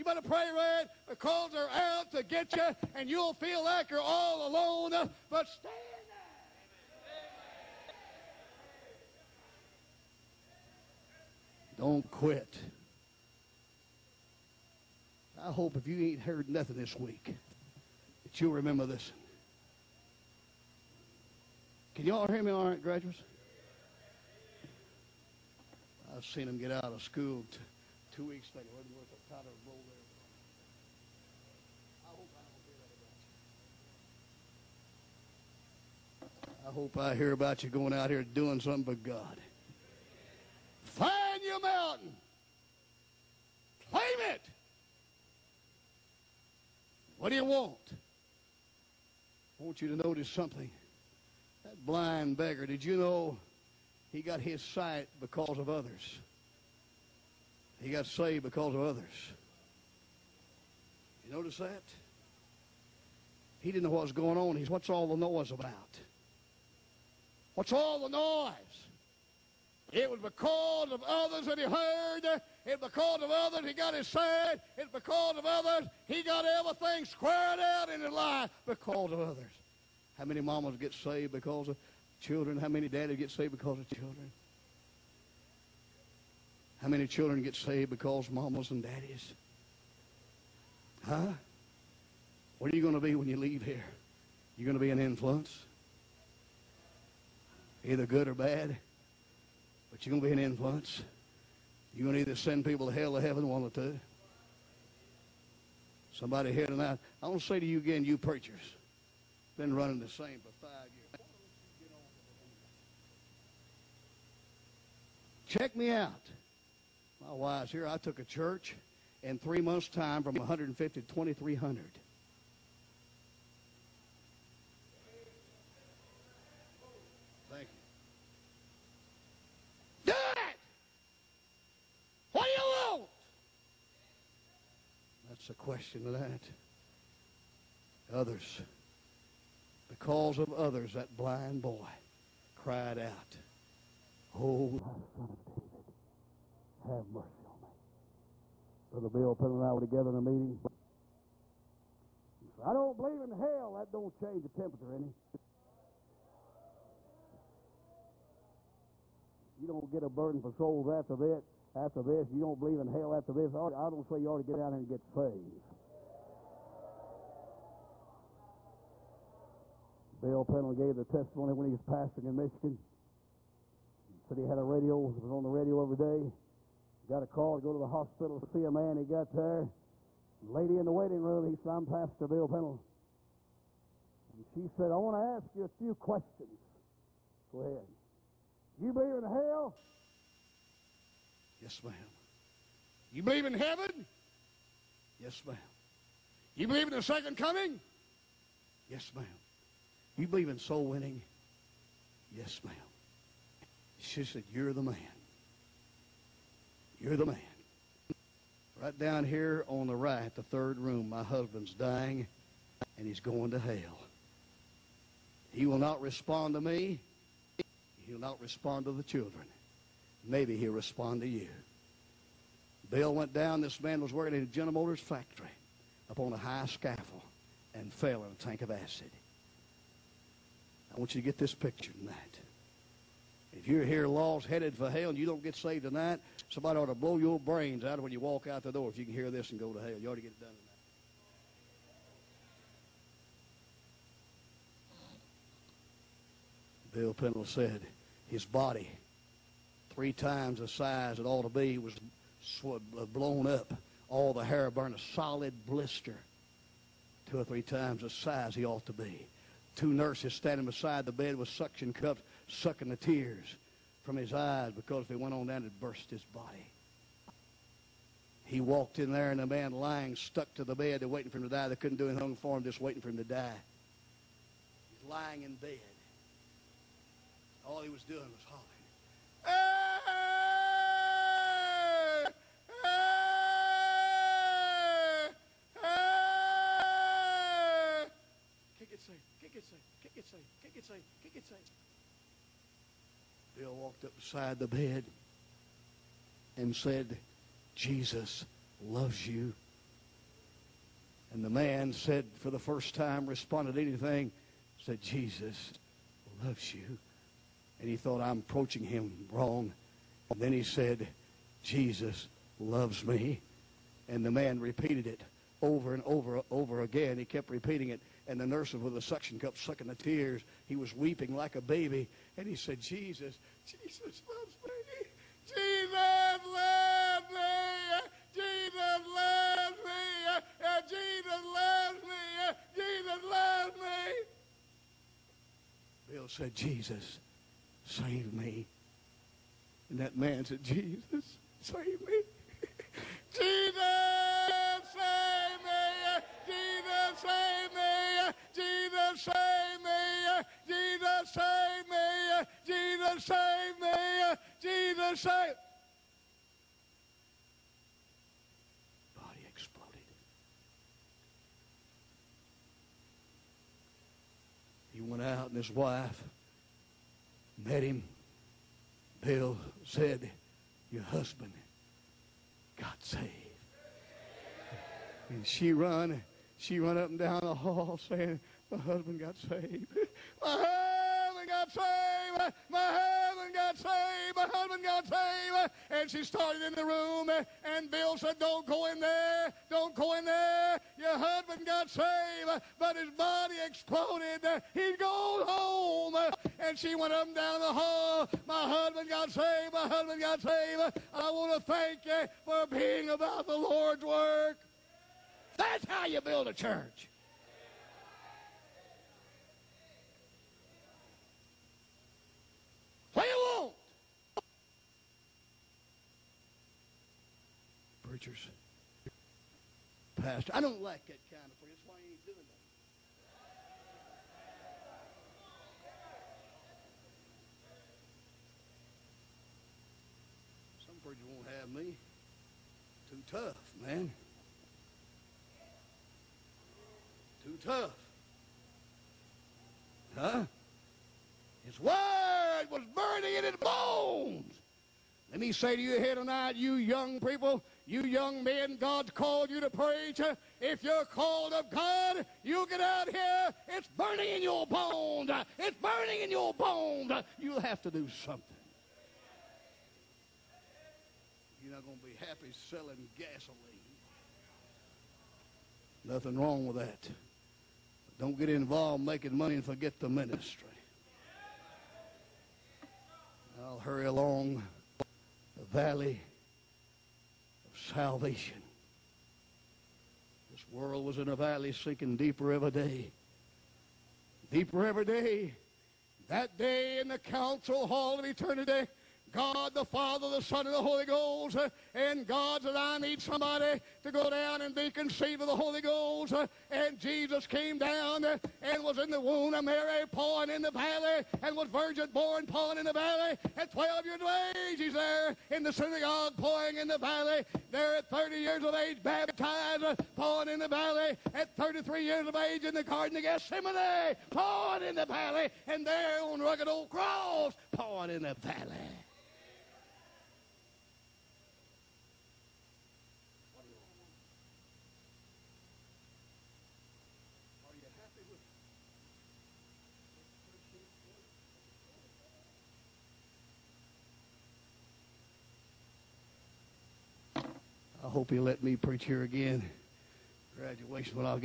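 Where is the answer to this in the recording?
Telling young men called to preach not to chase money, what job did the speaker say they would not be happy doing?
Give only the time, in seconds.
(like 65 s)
462 s.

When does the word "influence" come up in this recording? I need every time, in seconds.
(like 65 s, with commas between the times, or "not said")
94 s, 100 s.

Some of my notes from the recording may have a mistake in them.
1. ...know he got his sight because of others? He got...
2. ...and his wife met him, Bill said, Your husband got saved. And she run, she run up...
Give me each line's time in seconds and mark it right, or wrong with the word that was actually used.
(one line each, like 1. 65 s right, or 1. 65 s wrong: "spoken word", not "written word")
1. 52 s right
2. 365 s right.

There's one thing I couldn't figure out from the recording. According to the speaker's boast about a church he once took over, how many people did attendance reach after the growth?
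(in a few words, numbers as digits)
2,300.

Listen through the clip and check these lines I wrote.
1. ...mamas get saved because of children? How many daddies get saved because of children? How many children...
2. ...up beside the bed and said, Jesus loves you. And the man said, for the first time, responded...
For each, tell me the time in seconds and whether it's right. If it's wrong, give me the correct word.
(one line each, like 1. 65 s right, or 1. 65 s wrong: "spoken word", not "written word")
1. 80 s right
2. 294 s right.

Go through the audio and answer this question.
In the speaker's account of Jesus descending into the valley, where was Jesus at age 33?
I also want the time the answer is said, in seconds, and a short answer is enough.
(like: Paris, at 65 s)
Garden of Gethsemane, at 512 s.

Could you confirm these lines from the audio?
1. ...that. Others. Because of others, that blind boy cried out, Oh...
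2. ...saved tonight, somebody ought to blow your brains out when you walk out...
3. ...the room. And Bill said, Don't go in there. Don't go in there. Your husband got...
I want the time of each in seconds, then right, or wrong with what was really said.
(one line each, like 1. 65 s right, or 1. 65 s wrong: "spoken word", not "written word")
1. 136 s right
2. 235 s right
3. 386 s right.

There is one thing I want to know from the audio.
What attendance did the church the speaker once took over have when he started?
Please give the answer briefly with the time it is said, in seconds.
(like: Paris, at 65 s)
150, at 120 s.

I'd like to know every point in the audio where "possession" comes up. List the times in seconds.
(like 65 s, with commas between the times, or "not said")
not said.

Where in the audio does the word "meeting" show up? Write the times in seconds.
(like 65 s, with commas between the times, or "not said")
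150 s.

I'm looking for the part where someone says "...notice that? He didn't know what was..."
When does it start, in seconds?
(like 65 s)
61 s.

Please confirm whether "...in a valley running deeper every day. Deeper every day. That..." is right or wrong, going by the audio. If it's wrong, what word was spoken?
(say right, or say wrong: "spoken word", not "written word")
wrong: "sinking", not "running".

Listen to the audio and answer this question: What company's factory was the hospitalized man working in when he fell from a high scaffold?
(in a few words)
General Motors.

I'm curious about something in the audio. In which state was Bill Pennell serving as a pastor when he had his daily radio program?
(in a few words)
Michigan.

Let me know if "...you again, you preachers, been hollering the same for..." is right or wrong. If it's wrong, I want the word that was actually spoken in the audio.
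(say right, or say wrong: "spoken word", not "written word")
wrong: "running", not "hollering".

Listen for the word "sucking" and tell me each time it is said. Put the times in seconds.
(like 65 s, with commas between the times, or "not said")
262 s, 319 s.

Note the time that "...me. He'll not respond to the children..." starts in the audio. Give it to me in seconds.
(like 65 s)
216 s.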